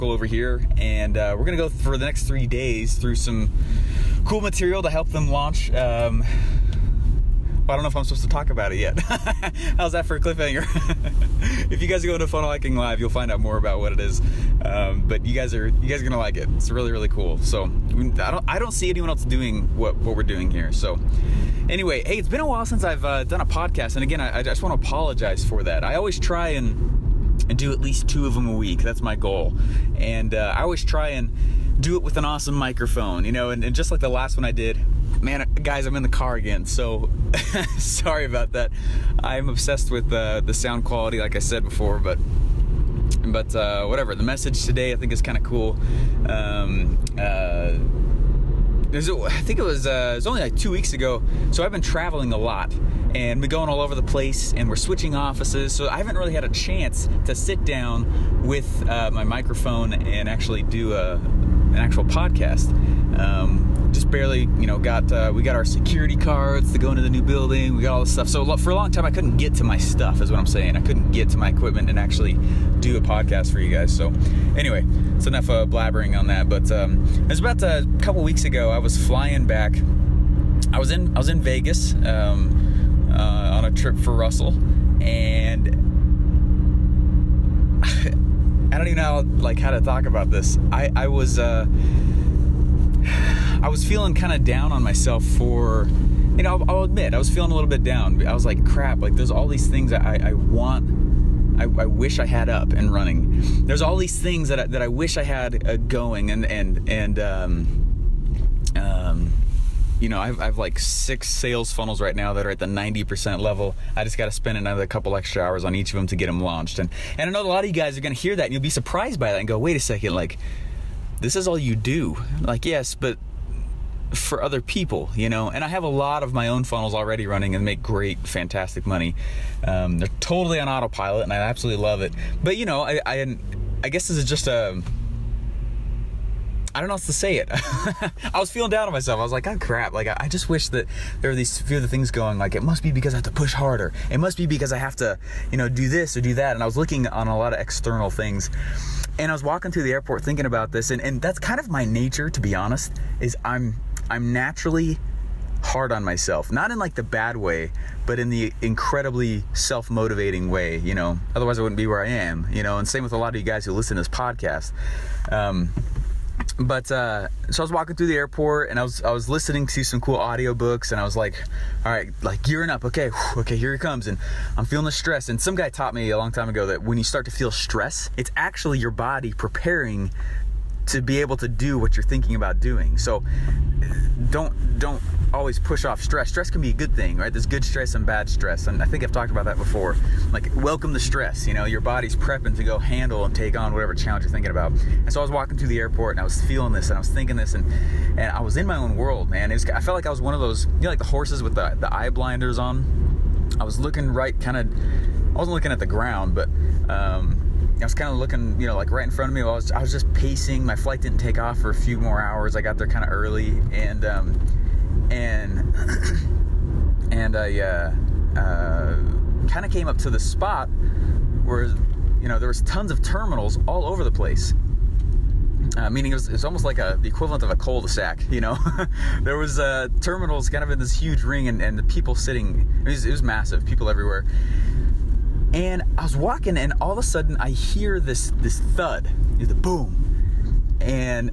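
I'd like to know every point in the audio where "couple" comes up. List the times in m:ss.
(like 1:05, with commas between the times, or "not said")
1:17, 1:54.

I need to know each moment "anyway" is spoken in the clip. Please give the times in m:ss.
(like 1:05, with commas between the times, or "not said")
0:21, 1:14.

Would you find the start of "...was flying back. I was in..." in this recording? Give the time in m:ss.
1:18.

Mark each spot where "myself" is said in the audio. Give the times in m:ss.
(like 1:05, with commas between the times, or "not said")
1:34, 2:18, 2:36.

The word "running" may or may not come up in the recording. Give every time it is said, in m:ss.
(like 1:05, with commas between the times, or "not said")
1:42, 2:07.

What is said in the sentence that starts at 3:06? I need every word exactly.
Stress can be a good thing, right?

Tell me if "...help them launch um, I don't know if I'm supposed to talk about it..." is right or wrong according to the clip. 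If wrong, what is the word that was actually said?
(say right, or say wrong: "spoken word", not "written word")
right.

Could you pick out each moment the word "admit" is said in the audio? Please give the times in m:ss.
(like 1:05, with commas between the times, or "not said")
1:36.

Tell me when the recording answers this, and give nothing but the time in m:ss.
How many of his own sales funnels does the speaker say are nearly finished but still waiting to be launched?
1:50.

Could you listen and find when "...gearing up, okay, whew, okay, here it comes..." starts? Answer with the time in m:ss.
2:52.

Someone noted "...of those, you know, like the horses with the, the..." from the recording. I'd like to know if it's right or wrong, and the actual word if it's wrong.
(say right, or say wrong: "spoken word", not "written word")
right.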